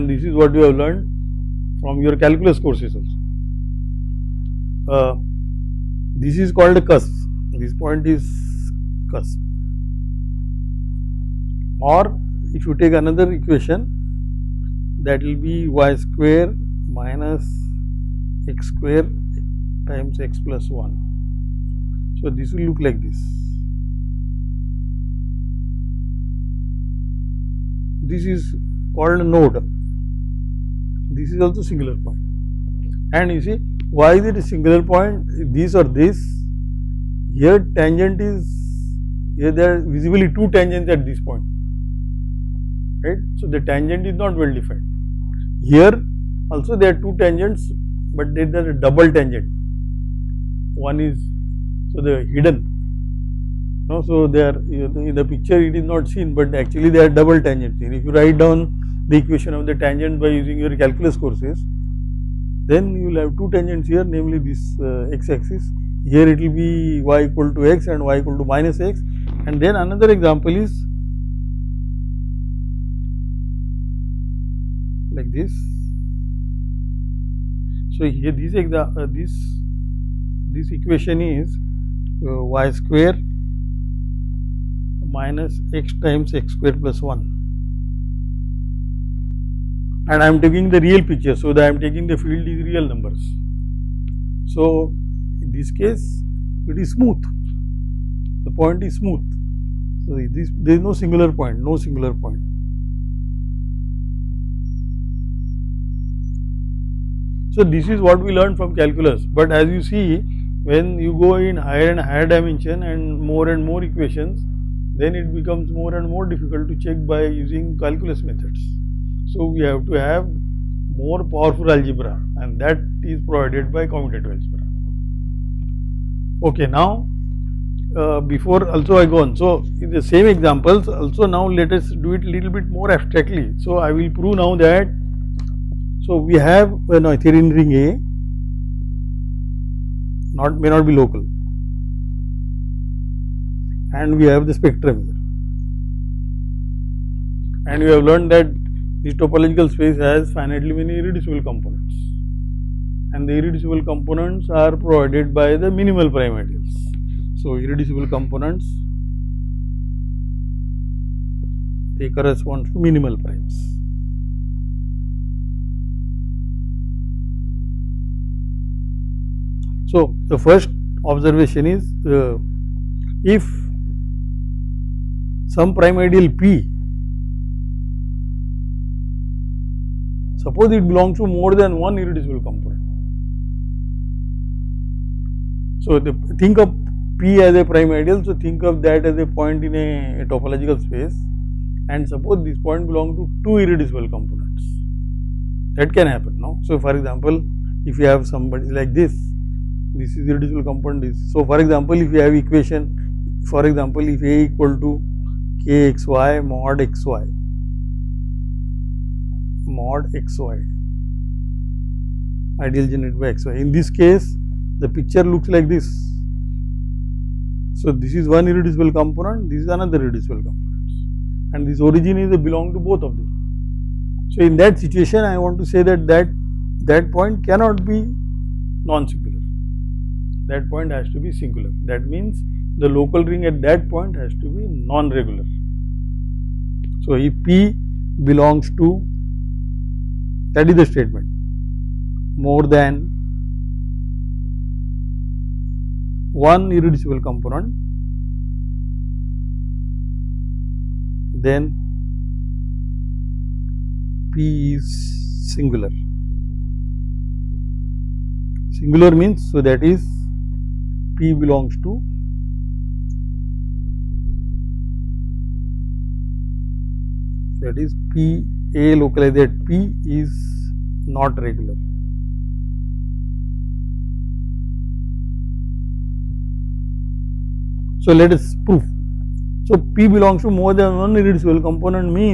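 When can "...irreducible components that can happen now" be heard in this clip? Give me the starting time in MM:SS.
03:13.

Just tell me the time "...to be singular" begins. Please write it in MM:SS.
03:51.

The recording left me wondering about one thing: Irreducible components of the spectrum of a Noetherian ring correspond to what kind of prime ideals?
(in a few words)
minimal primes.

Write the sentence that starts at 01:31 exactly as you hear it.
So, I am taking the field is real numbers.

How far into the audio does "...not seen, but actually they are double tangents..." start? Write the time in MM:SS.
00:55.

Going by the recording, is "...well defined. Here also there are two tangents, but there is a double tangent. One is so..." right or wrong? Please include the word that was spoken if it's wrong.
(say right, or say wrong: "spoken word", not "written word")
right.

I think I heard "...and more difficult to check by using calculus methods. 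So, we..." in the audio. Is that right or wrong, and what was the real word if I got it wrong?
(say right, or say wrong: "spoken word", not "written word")
right.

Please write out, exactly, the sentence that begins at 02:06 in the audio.
Okay, now uh, before also I go on.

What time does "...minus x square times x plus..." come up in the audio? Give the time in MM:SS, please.
00:16.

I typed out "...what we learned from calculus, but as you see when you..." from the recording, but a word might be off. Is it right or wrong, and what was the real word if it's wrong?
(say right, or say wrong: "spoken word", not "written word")
right.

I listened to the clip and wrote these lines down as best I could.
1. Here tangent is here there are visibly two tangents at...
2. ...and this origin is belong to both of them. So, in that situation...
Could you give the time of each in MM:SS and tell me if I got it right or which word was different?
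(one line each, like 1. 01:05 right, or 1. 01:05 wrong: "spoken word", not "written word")
1. 00:37 right
2. 03:41 right.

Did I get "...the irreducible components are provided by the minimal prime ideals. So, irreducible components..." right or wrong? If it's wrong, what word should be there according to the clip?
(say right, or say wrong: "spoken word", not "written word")
right.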